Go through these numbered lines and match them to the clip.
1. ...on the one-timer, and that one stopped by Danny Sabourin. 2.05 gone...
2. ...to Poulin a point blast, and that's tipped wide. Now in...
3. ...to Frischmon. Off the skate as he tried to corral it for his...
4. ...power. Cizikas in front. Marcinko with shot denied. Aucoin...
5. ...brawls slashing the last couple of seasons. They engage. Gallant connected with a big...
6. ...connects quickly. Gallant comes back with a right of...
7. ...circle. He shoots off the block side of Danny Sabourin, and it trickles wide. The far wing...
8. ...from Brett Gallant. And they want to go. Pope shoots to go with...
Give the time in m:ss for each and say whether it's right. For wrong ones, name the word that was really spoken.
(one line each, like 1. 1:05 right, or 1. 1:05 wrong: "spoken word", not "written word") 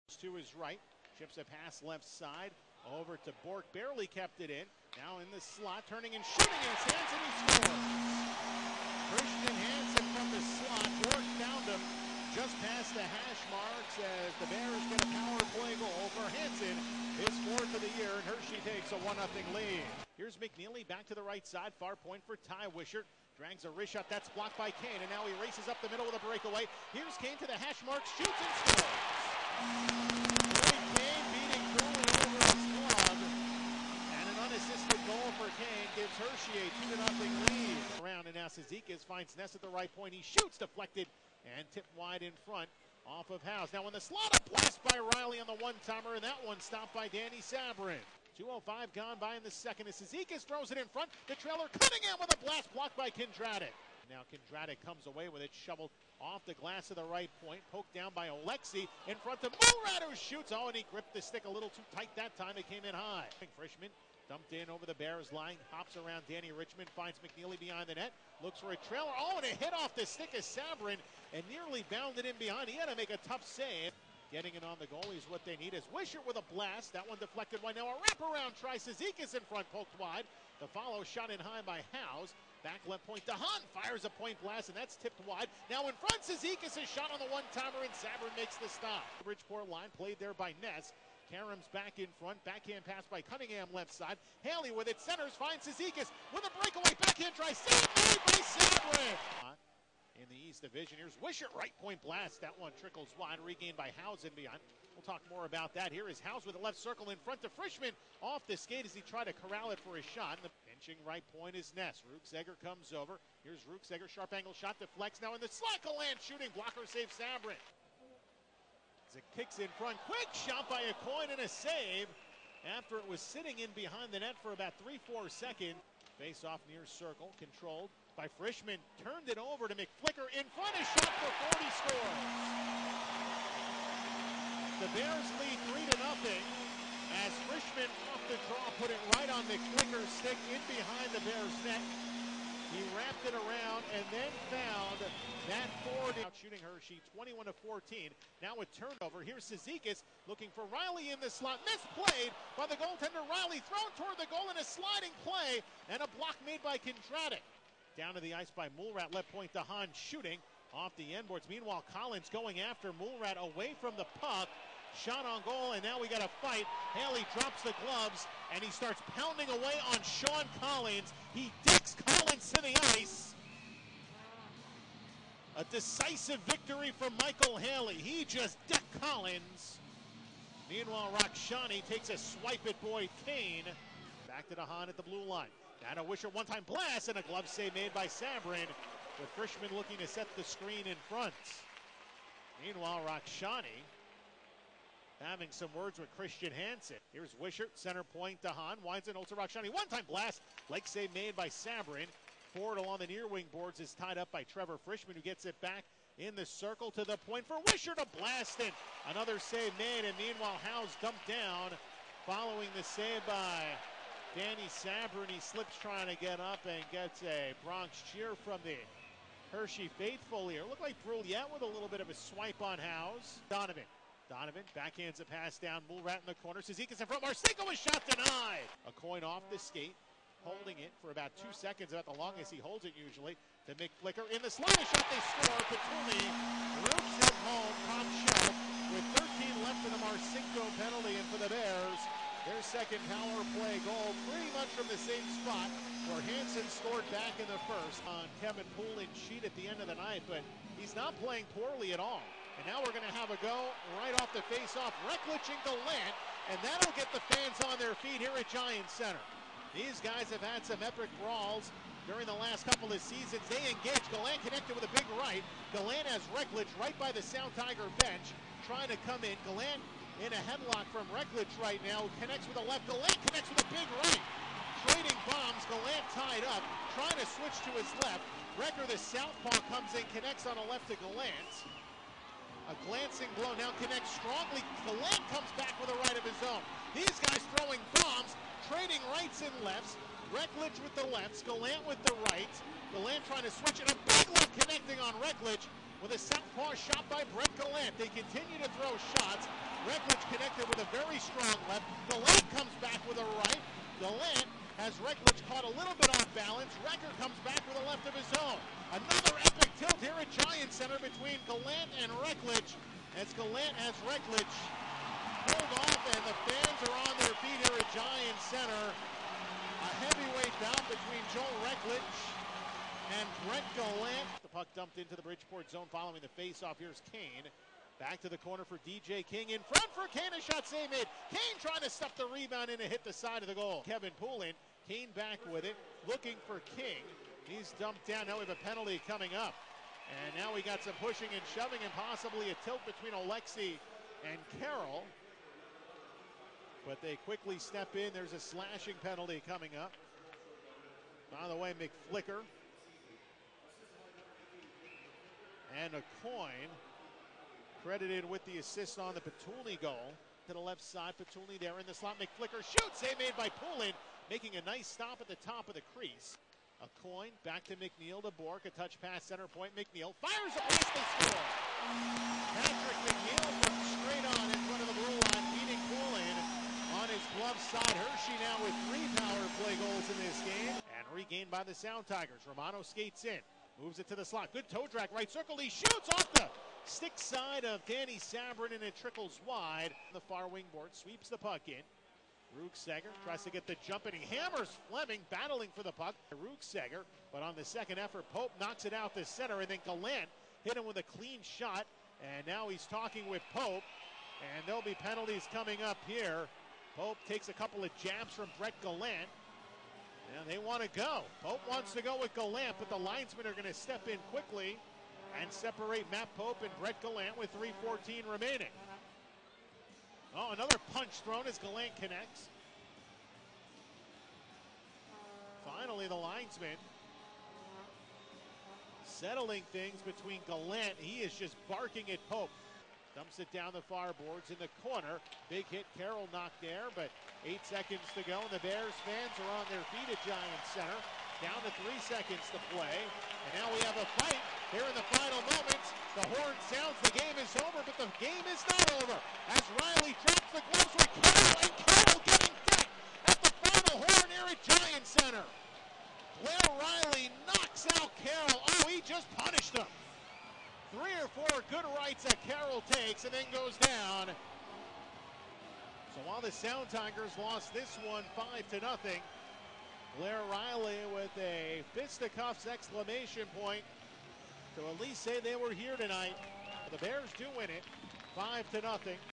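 1. 0:45 right
2. 1:23 wrong: "Fires", not "Poulin"
3. 1:47 right
4. 3:46 wrong: "corner", not "power"
5. 4:21 wrong: "during", not "slashing"
6. 4:43 wrong: "strongly", not "quickly"
7. 6:25 wrong: "stick", not "block"
8. 6:48 wrong: "wants", not "shoots".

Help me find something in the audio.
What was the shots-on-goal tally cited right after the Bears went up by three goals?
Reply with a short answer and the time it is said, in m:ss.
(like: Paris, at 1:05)
21 to 14, at 2:27.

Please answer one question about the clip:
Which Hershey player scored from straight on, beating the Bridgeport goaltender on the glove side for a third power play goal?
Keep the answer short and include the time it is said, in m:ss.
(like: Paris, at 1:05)
Patrick McNeill, at 6:12.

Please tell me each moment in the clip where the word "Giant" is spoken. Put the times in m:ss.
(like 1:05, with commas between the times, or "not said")
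4:18, 5:10, 5:17, 7:20, 7:34.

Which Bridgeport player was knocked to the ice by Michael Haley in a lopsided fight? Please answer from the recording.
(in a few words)
Sean Collins.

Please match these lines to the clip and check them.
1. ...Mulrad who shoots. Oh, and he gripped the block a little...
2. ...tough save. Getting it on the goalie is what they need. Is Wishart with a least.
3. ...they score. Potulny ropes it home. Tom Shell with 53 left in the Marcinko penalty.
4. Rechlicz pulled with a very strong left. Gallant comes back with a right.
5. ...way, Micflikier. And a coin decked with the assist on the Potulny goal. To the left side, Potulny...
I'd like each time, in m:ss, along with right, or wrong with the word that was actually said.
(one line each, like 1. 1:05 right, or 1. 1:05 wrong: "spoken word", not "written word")
1. 0:59 wrong: "stick", not "block"
2. 1:13 wrong: "blast", not "least"
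3. 3:55 wrong: "13", not "53"
4. 4:59 wrong: "connected", not "pulled"
5. 5:51 wrong: "credited", not "decked".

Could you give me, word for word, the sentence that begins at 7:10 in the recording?
He is just barking at Pope.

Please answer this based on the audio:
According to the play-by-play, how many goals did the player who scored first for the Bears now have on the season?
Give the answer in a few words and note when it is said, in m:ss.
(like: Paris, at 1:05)
4, at 0:17.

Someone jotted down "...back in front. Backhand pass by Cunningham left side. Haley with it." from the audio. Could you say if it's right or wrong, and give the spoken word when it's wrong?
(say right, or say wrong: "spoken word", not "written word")
right.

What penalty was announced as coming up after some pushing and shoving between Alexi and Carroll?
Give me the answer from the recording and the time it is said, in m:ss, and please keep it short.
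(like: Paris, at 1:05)
Slashing, at 5:48.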